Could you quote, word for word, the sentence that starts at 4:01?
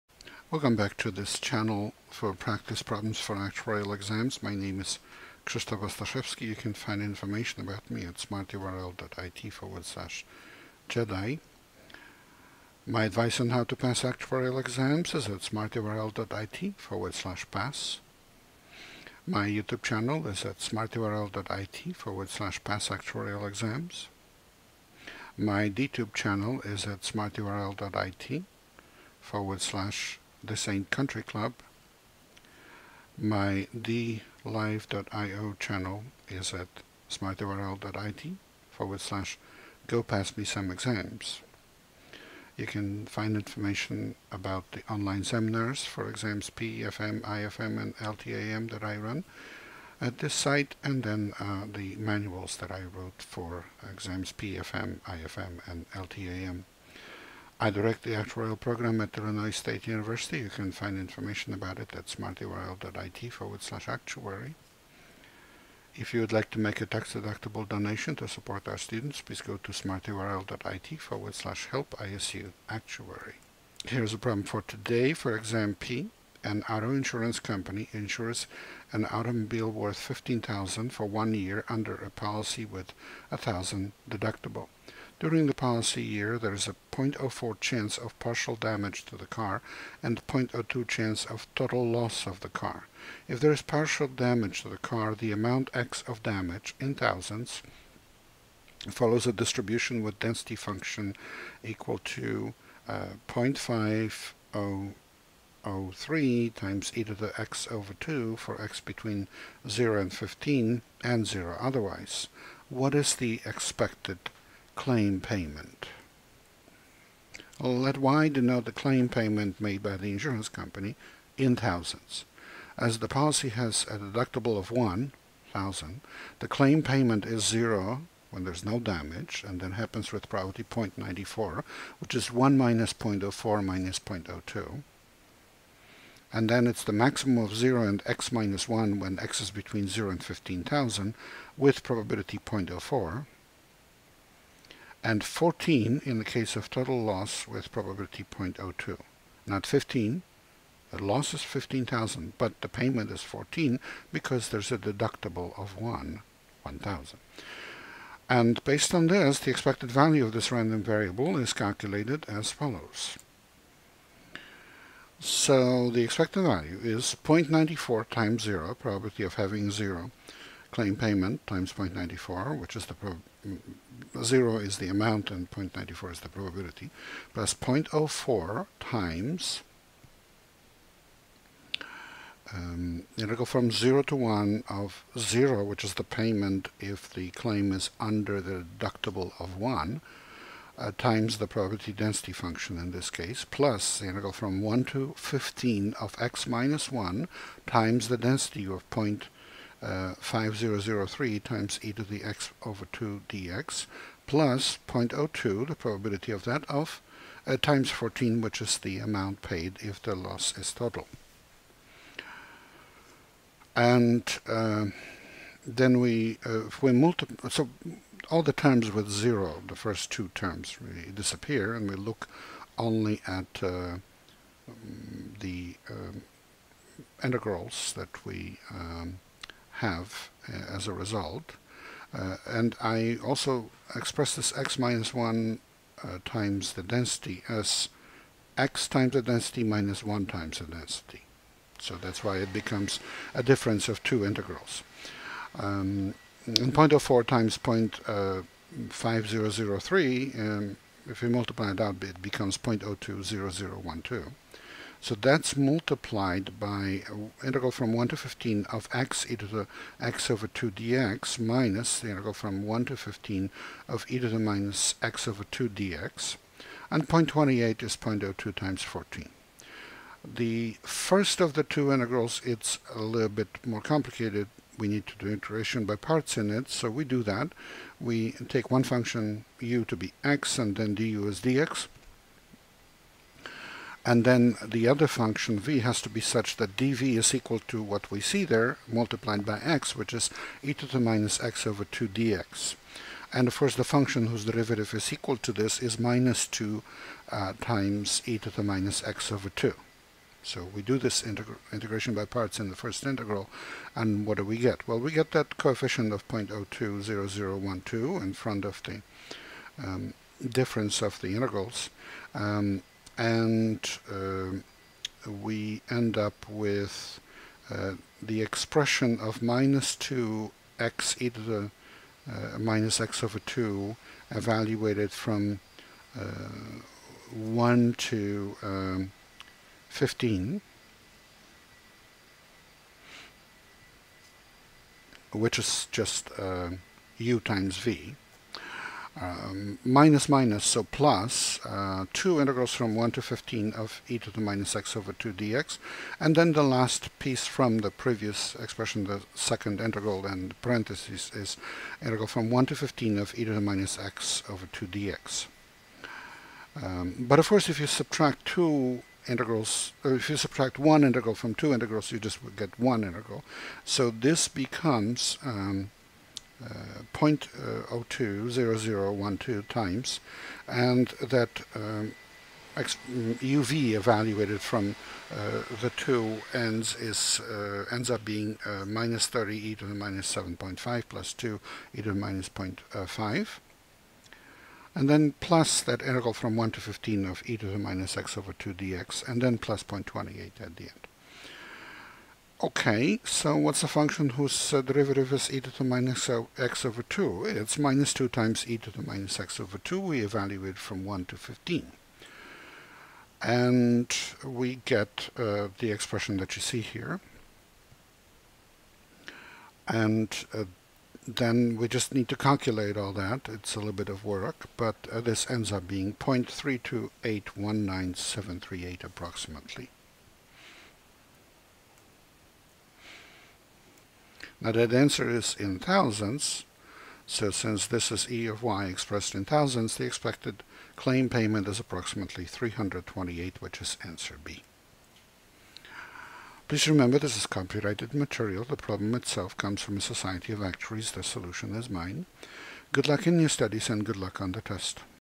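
So that's why it becomes a difference of two integrals.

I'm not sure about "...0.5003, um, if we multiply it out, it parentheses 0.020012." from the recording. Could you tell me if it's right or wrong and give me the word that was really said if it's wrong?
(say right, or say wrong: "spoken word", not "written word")
wrong: "becomes", not "parentheses".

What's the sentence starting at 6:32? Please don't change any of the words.
Okay, so what's a function whose uh, derivative is e to the minus x over 2?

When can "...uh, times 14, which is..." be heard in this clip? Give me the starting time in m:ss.
3:27.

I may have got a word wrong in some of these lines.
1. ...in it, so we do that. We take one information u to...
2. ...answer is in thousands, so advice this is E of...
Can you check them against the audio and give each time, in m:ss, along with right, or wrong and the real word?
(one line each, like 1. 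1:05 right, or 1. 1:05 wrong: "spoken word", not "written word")
1. 4:36 wrong: "function", not "information"
2. 7:04 wrong: "since", not "advice".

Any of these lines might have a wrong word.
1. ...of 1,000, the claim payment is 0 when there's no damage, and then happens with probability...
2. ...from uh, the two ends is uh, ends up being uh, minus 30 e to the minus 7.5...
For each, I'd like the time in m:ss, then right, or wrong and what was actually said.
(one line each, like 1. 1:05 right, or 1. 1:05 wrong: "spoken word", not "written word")
1. 2:04 right
2. 6:14 right.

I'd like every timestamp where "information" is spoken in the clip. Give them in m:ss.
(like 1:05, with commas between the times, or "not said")
0:07, 0:43, 1:00.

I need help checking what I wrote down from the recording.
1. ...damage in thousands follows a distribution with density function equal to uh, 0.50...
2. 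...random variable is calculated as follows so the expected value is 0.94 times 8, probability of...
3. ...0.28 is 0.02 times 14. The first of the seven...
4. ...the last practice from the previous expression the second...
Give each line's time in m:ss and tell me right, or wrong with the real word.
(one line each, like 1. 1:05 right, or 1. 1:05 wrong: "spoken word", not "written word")
1. 1:36 right
2. 2:40 wrong: "0", not "8"
3. 4:27 wrong: "two", not "seven"
4. 5:46 wrong: "piece", not "practice".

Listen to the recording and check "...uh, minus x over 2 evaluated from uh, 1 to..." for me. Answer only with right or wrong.
right.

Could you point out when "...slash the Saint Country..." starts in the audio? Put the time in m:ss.
0:29.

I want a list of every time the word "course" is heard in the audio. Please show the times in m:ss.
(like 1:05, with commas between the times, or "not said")
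4:53, 5:57.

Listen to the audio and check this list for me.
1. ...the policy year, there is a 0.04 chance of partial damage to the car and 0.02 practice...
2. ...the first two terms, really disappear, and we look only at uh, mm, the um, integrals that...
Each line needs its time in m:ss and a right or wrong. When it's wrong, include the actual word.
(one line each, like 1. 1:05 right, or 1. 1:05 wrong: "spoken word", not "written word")
1. 1:25 wrong: "chance", not "practice"
2. 3:39 right.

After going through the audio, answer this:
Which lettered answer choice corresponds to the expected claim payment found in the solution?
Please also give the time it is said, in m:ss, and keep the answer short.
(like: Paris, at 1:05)
B, at 7:14.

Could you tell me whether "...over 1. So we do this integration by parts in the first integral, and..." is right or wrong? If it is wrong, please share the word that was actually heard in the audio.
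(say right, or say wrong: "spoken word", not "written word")
wrong: "2", not "1".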